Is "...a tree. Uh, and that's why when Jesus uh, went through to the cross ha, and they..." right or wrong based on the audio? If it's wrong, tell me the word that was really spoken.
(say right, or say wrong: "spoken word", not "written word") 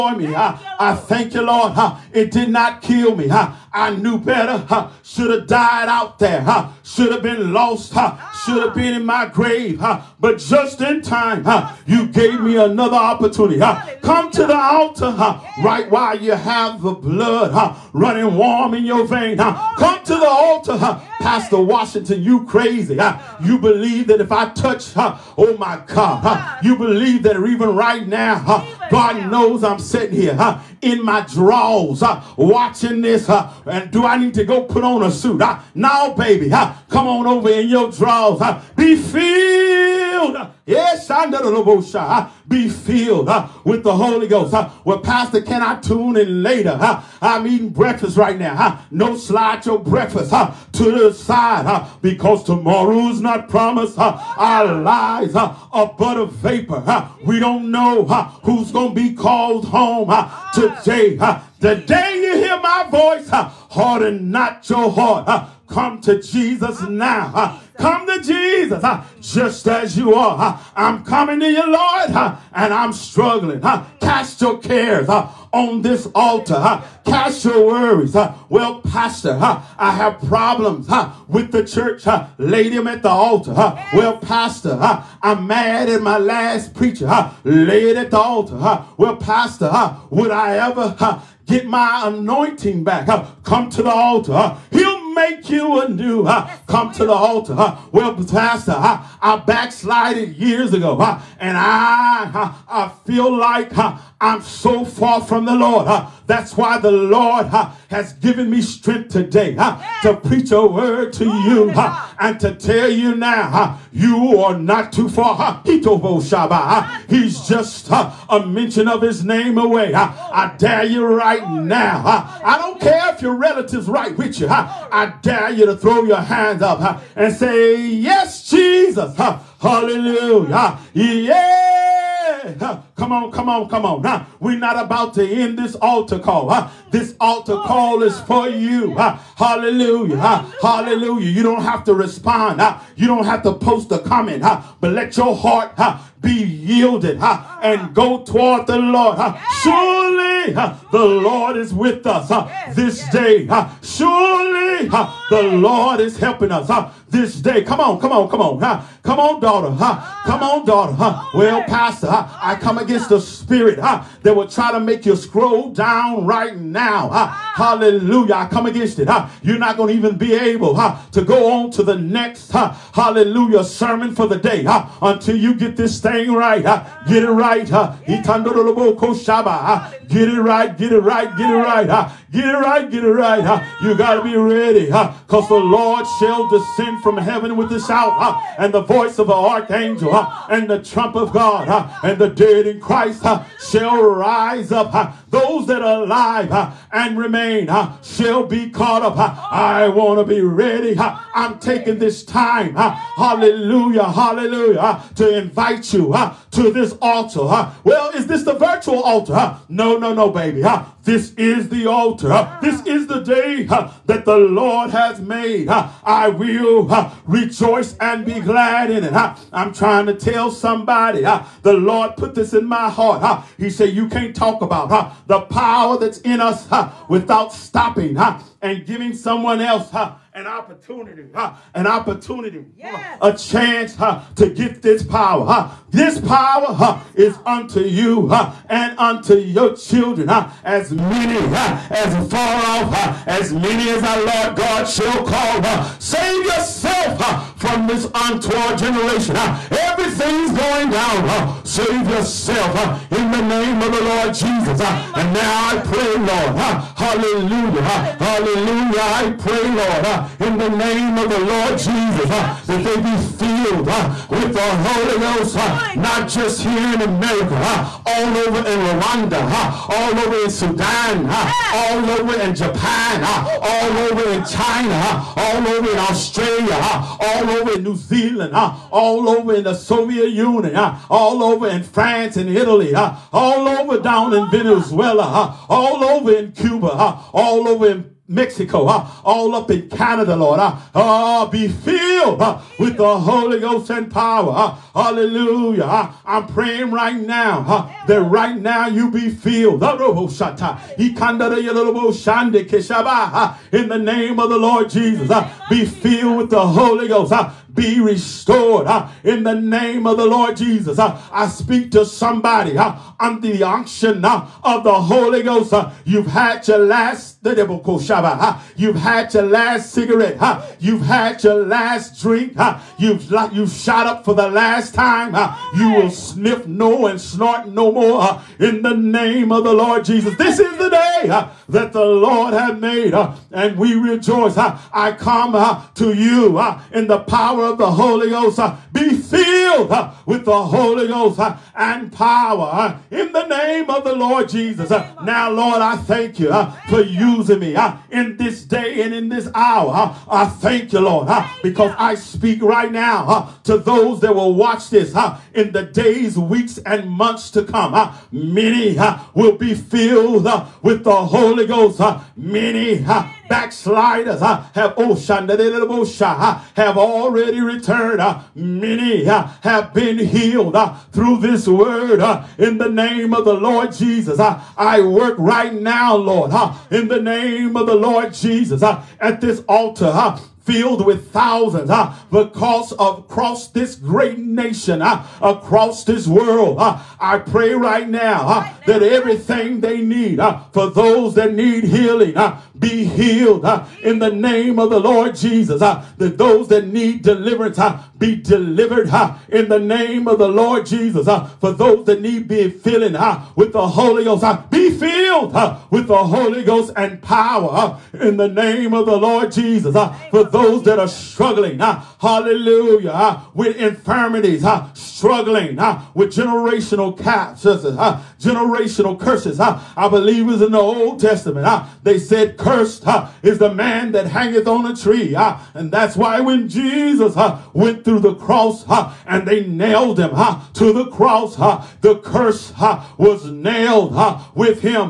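right.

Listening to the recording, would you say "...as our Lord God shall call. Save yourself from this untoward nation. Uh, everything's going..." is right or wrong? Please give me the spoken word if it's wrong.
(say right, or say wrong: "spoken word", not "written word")
wrong: "generation", not "nation".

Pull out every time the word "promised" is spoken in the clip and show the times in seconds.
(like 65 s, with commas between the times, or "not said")
53 s.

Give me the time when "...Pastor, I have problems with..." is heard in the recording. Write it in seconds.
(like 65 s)
78 s.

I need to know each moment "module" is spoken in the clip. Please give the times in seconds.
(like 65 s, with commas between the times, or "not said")
not said.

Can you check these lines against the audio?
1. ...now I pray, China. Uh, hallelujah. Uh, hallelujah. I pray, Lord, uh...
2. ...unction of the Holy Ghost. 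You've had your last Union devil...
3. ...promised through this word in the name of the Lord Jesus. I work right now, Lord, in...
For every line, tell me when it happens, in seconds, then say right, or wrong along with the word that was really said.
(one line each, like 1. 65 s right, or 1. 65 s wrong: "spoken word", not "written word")
1. 255 s wrong: "Lord", not "China"
2. 313 s wrong: "The", not "Union"
3. 370 s wrong: "healed", not "promised".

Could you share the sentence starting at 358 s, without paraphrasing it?
Many will be filled with the Holy Ghost.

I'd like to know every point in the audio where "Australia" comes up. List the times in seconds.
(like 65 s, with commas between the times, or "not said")
275 s.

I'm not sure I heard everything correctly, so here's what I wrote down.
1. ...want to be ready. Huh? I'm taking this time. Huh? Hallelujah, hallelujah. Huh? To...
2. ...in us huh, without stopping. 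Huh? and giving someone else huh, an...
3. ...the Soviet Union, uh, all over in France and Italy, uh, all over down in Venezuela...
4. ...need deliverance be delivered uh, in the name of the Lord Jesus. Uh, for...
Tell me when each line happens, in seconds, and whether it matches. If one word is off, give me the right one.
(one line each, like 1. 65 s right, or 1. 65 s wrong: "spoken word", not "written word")
1. 199 s right
2. 226 s right
3. 279 s right
4. 396 s right.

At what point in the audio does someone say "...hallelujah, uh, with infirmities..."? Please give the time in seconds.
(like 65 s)
412 s.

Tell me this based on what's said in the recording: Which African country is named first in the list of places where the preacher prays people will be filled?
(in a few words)
Rwanda.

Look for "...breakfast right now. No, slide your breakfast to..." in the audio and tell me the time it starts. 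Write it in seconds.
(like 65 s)
47 s.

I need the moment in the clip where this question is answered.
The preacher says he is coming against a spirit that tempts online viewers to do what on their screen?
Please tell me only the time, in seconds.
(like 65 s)
165 s.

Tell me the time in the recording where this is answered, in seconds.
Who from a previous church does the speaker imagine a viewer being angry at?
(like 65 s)
86 s.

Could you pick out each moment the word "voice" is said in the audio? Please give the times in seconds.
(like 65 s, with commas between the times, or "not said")
62 s, 188 s.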